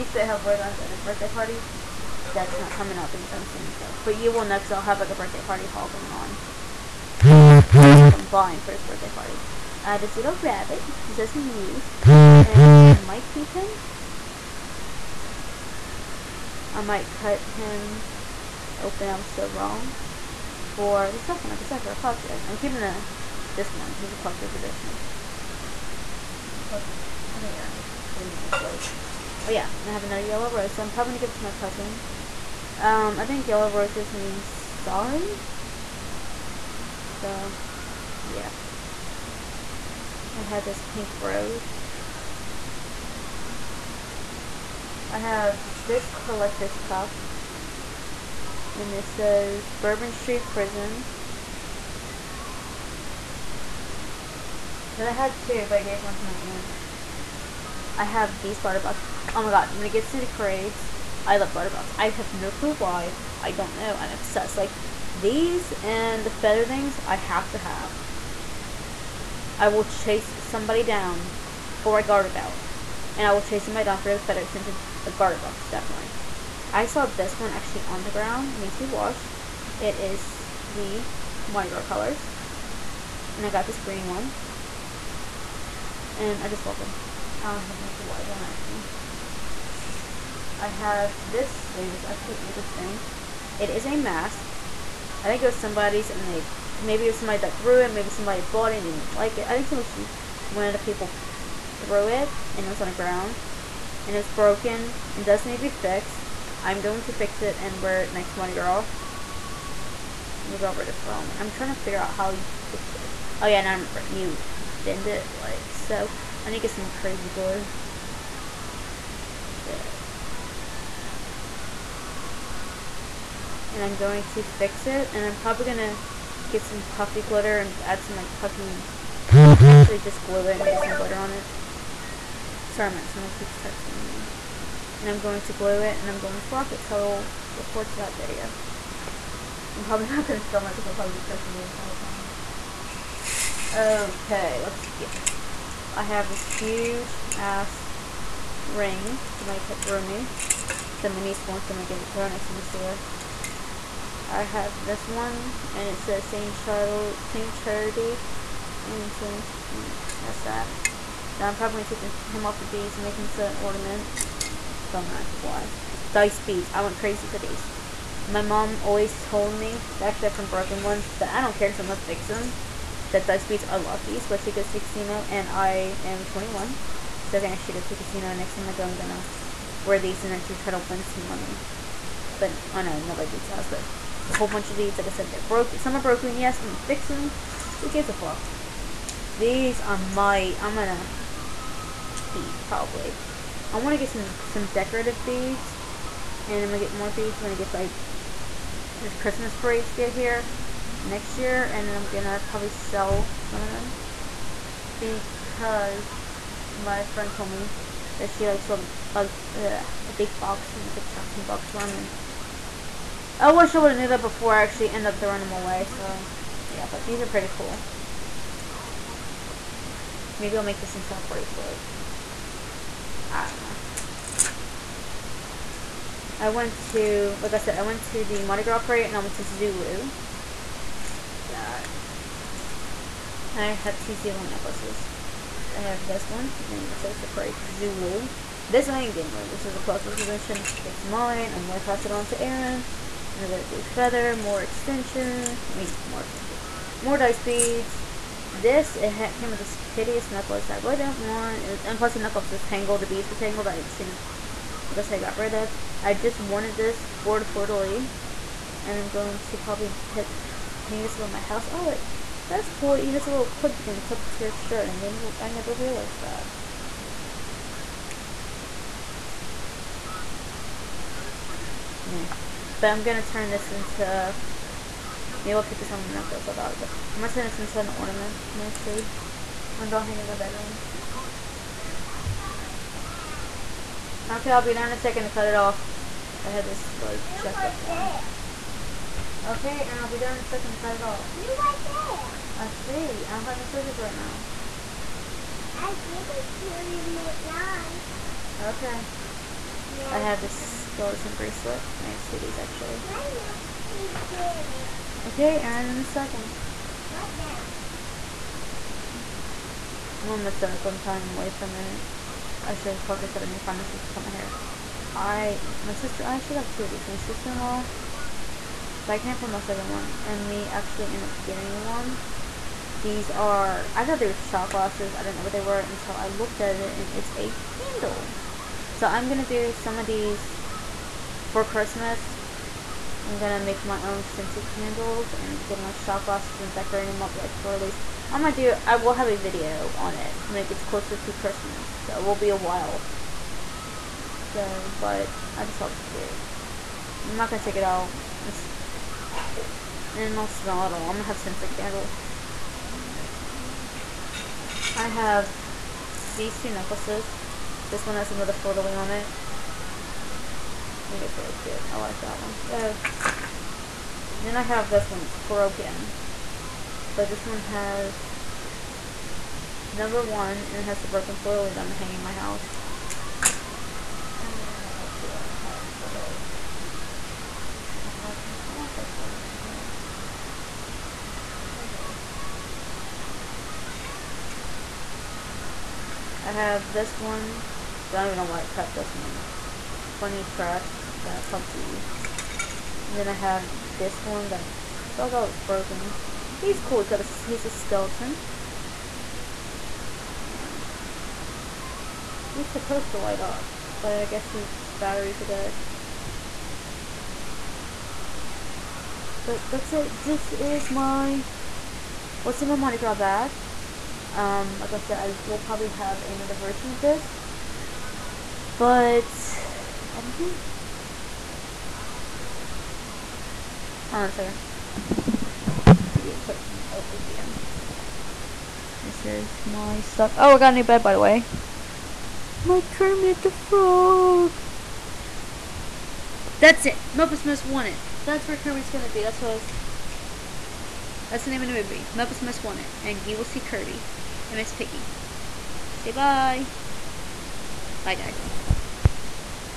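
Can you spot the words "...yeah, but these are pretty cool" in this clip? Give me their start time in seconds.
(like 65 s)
216 s.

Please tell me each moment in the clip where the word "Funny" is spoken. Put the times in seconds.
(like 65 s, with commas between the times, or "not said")
390 s.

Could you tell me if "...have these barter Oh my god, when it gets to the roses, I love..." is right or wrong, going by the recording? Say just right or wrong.
wrong.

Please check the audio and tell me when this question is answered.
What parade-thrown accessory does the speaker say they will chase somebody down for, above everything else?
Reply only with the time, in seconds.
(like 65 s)
75 s.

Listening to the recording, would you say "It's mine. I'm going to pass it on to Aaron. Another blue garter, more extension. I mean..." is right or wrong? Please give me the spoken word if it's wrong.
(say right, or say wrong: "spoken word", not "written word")
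wrong: "feather", not "garter".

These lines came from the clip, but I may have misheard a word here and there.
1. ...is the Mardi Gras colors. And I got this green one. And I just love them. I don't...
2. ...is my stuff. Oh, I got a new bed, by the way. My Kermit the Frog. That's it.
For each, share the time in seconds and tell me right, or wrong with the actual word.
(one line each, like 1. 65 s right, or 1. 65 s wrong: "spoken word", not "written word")
1. 79 s right
2. 429 s right.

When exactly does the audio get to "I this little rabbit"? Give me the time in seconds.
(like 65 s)
9 s.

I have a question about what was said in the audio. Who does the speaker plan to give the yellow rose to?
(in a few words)
Cousin.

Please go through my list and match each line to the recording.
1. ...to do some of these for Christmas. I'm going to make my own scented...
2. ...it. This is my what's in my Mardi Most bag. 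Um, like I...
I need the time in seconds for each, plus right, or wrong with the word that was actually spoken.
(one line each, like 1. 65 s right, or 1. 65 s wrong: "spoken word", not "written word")
1. 329 s right
2. 409 s wrong: "Gras", not "Most".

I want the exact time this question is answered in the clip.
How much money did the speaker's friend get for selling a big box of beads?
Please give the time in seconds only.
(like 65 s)
211 s.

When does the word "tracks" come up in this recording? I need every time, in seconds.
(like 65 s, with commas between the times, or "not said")
390 s.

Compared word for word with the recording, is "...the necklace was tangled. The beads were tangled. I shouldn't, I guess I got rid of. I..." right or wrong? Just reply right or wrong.
right.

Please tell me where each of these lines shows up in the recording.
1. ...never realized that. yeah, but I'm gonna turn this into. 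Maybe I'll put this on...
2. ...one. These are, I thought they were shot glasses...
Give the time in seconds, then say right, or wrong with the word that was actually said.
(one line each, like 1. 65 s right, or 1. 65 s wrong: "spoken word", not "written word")
1. 265 s right
2. 321 s right.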